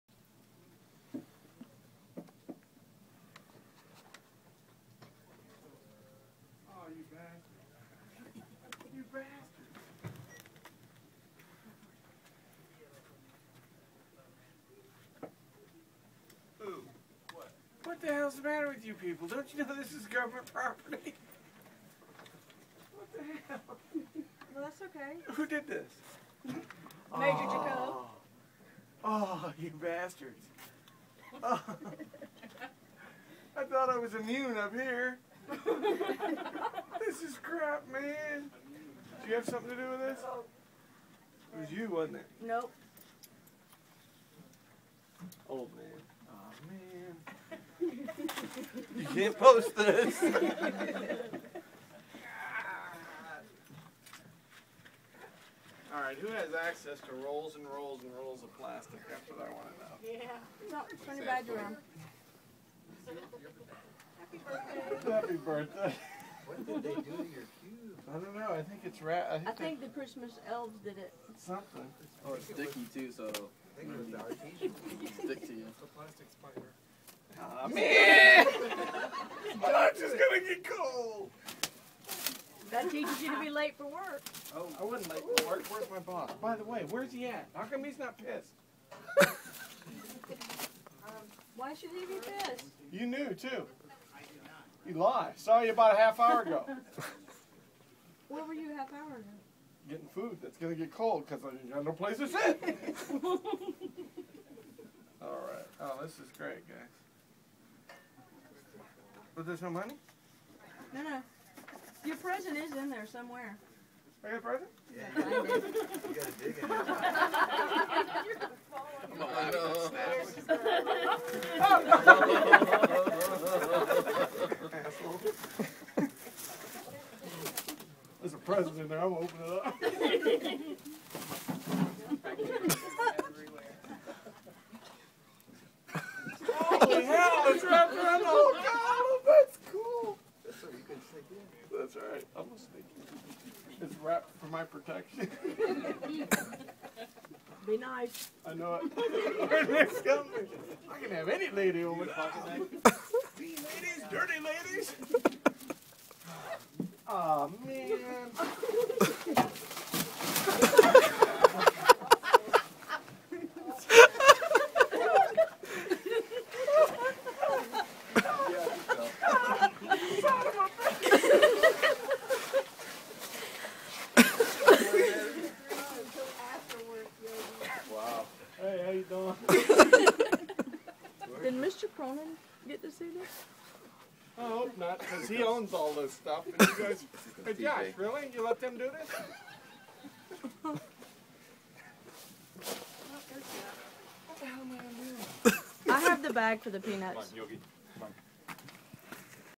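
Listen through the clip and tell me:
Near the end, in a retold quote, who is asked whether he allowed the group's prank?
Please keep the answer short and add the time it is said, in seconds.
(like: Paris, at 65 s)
Josh, at 187 s.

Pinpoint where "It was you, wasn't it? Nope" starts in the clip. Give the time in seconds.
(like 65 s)
41 s.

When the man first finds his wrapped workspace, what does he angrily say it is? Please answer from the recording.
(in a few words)
government property.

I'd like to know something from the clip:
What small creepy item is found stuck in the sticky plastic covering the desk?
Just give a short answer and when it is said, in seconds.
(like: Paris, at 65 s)
A plastic spider, at 75 s.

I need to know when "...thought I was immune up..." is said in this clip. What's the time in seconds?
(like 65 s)
33 s.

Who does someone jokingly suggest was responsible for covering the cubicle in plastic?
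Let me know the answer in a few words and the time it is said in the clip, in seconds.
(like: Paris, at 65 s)
The Christmas elves, at 69 s.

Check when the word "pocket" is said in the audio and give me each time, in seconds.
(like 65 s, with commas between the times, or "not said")
152 s.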